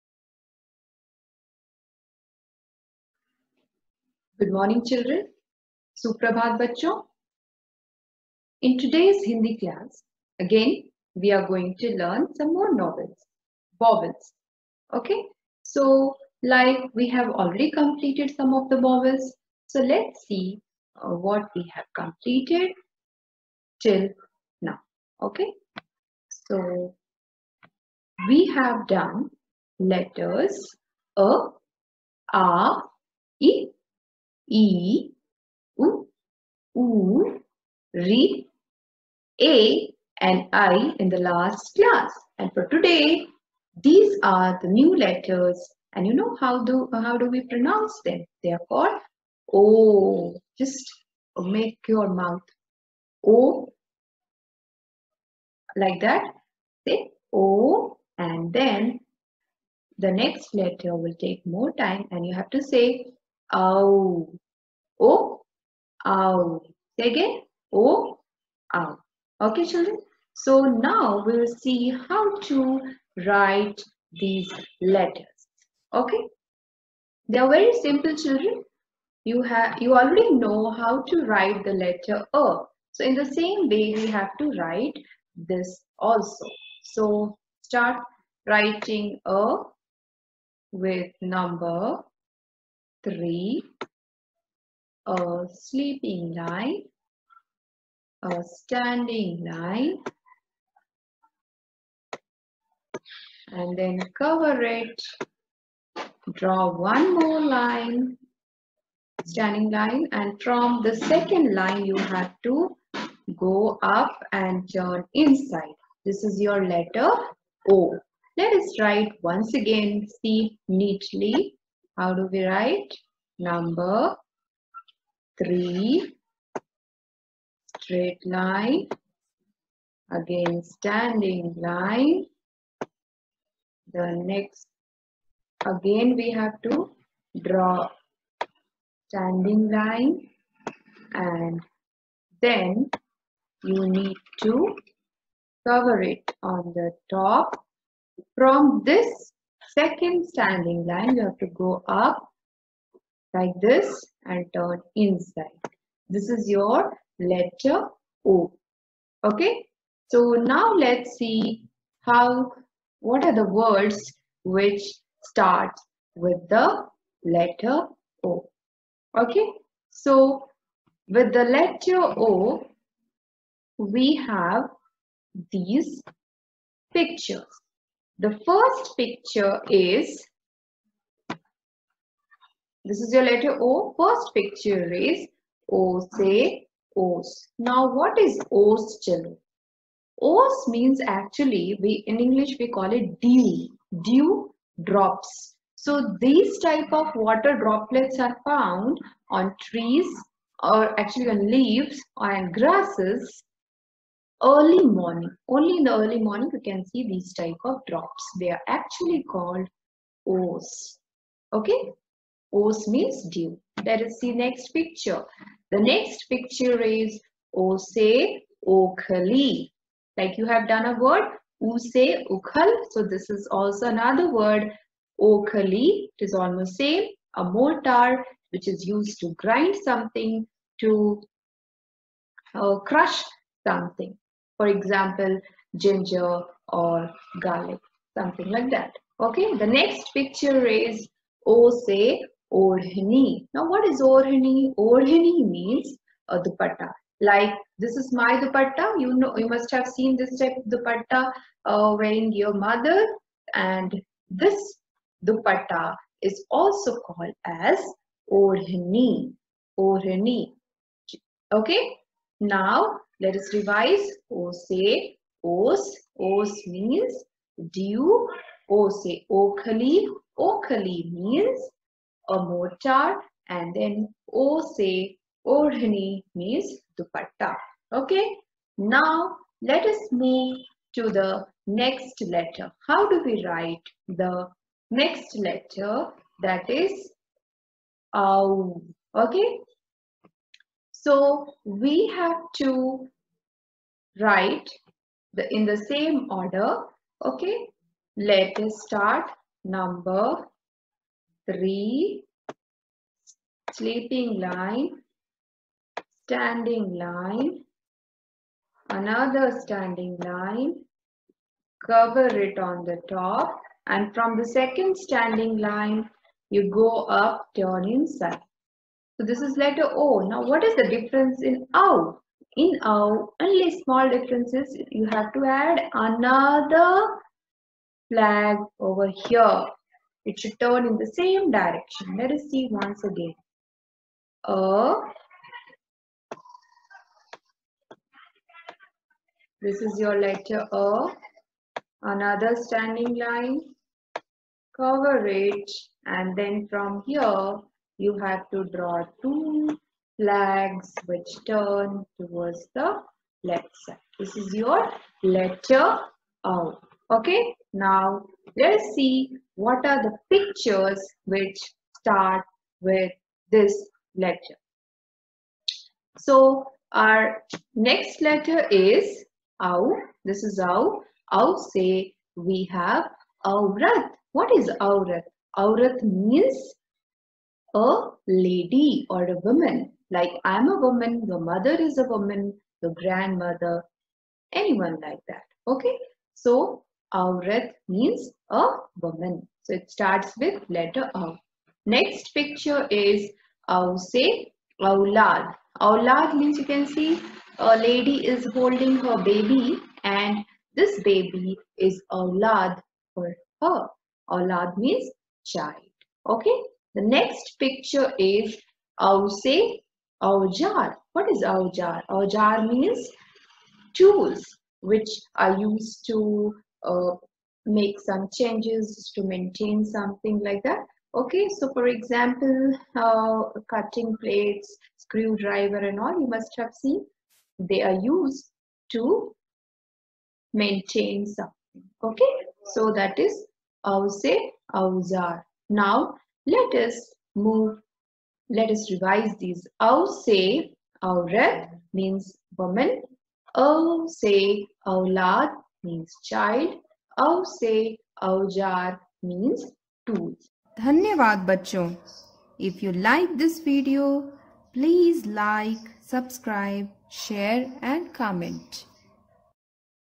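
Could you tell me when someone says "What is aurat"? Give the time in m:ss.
6:14.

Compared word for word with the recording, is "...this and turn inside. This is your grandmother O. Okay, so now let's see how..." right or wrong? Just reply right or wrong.
wrong.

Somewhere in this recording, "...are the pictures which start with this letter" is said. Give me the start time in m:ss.
5:59.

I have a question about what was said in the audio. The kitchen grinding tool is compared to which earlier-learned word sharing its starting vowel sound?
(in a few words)
Ukhal.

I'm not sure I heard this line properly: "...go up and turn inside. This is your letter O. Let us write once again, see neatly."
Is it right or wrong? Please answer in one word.
right.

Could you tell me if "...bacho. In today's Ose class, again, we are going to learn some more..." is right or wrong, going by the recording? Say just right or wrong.
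wrong.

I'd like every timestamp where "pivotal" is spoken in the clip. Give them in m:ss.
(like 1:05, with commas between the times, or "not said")
not said.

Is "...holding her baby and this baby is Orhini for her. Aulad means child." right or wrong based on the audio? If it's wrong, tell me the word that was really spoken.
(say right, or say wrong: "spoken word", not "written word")
wrong: "Aulad", not "Orhini".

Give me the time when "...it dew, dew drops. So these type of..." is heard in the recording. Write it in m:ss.
3:12.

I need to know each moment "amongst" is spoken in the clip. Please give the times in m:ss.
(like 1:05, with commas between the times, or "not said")
not said.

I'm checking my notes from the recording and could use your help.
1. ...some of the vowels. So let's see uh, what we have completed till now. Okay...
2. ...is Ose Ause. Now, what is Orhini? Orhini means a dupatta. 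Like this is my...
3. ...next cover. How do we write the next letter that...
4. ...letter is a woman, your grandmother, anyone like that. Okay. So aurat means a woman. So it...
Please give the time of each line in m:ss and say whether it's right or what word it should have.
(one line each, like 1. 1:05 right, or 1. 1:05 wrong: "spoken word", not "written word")
1. 0:18 right
2. 4:00 wrong: "Orhini", not "Ause"
3. 4:41 wrong: "letter", not "cover"
4. 6:21 wrong: "mother", not "letter".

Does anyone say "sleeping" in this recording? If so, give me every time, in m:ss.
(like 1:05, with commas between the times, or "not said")
1:35, 5:03.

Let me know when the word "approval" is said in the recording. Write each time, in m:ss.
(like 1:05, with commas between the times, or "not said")
not said.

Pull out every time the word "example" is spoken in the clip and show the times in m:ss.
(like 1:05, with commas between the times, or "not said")
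3:54, 7:01.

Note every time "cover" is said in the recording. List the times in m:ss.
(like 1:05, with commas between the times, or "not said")
1:44, 2:25, 5:11, 5:44.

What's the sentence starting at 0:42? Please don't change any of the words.
And for today, these are the new letters.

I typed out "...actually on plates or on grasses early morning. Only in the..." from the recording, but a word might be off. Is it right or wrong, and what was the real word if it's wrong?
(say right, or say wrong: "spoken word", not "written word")
wrong: "leaves", not "plates".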